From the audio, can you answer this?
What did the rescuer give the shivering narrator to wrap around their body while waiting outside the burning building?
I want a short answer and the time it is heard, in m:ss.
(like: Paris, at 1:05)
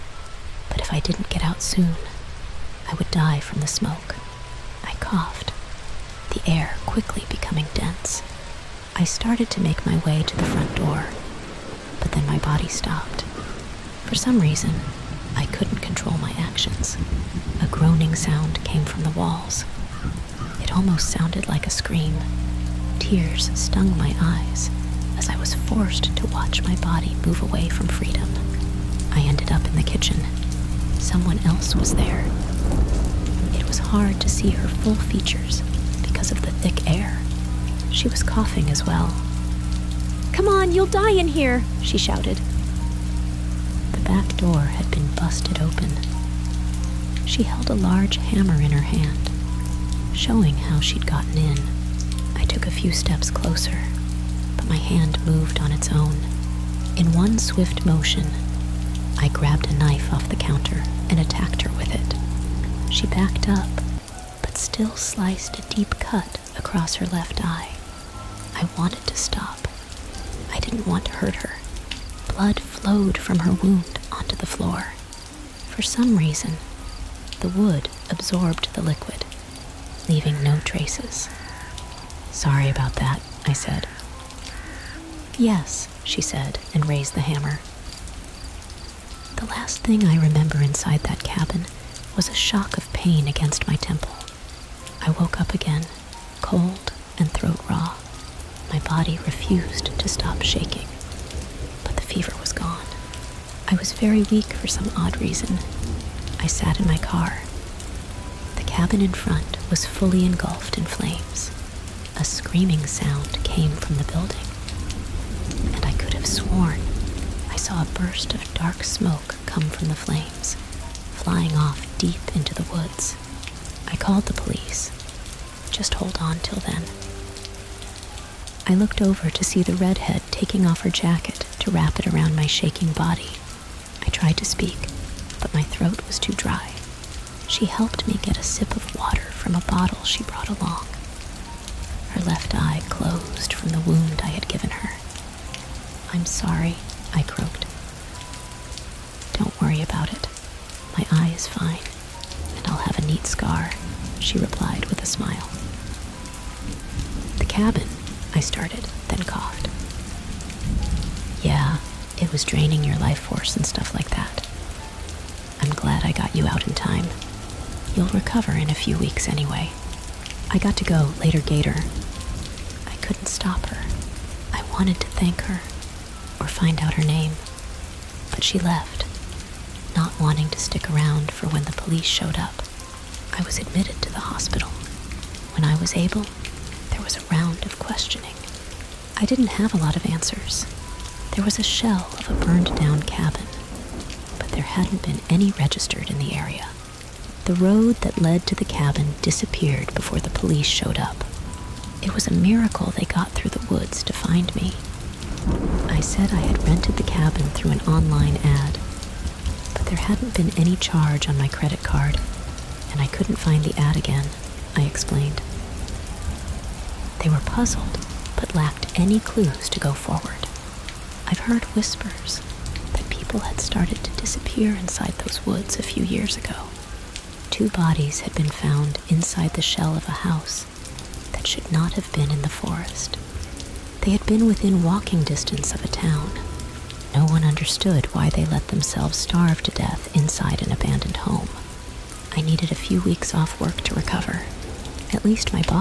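her jacket, at 2:10.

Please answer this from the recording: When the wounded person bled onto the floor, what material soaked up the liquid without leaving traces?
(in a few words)
wood.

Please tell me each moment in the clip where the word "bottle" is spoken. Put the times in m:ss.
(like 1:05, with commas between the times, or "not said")
2:19.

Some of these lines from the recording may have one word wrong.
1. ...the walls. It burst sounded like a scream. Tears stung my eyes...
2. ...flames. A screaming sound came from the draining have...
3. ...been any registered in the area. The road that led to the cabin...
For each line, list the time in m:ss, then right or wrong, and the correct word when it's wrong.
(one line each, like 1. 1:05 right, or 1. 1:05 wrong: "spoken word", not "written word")
1. 0:19 wrong: "almost", not "burst"
2. 1:50 wrong: "building", not "draining"
3. 3:15 right.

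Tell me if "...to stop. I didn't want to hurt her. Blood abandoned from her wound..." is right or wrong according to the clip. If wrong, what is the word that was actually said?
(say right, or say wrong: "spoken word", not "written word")
wrong: "flowed", not "abandoned".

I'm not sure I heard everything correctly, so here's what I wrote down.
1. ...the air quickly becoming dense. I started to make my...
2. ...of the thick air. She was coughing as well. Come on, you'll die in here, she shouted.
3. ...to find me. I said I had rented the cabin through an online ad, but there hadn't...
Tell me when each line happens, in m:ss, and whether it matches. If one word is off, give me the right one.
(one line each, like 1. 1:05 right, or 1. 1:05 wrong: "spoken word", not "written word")
1. 0:06 right
2. 0:36 right
3. 3:24 right.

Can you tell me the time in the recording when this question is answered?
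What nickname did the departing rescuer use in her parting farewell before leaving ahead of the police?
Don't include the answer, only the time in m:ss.
2:51.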